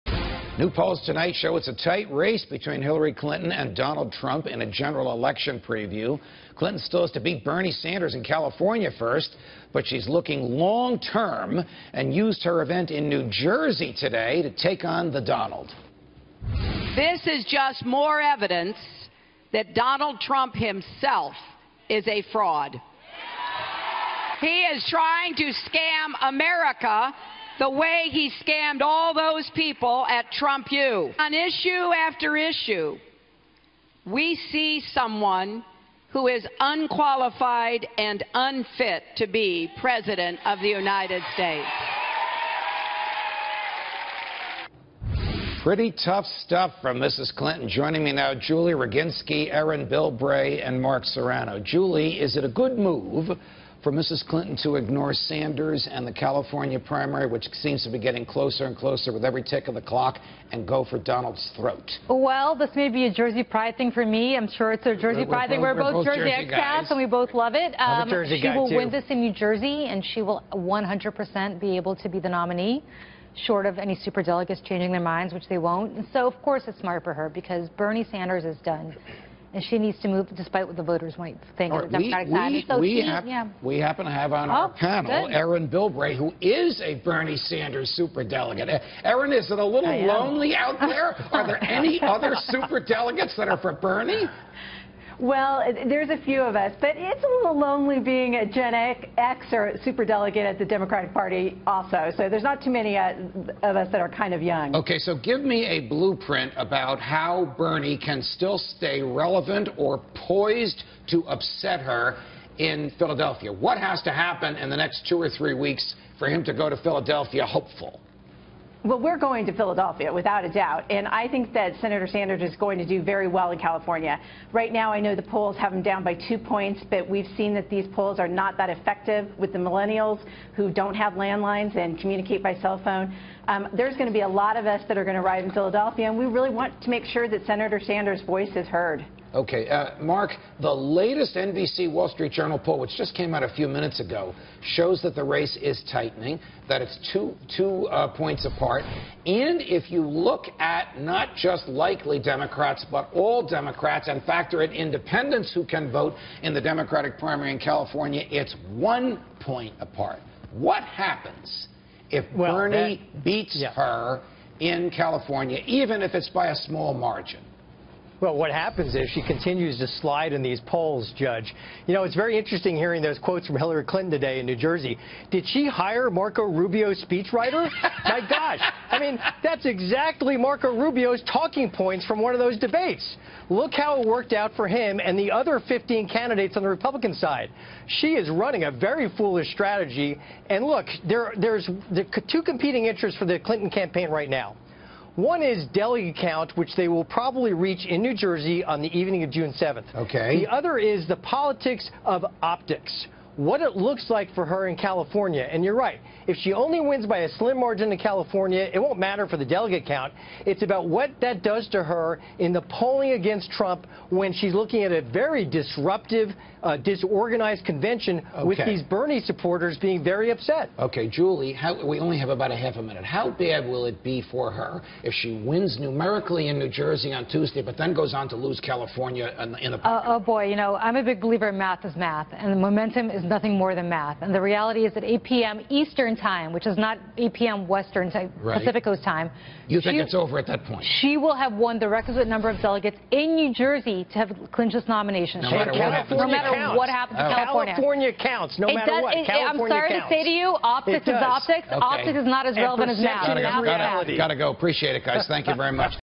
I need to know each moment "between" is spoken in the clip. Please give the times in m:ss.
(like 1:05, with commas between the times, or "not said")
0:02.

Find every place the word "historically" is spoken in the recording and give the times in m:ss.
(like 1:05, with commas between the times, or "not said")
not said.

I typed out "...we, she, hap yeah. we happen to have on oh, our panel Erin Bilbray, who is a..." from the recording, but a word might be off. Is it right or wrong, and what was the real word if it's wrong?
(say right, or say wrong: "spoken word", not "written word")
right.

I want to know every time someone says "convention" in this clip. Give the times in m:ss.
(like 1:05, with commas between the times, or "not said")
3:37.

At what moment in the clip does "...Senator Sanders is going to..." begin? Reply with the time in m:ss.
2:01.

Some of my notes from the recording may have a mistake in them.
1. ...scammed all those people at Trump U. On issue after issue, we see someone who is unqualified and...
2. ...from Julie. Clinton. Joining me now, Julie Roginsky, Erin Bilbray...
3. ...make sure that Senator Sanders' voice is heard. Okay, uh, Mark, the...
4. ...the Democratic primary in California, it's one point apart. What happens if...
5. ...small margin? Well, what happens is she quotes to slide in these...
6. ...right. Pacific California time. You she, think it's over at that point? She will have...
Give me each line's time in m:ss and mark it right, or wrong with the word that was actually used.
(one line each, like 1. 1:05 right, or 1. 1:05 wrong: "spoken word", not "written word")
1. 0:28 right
2. 0:46 wrong: "Mrs", not "Julie"
3. 2:16 right
4. 2:36 right
5. 2:46 wrong: "continues", not "quotes"
6. 3:58 wrong: "Coast", not "California".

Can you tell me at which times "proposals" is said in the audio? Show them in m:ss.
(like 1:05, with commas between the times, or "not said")
not said.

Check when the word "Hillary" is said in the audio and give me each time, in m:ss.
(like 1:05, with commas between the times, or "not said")
0:02, 2:53.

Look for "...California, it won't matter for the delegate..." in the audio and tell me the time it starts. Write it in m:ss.
3:27.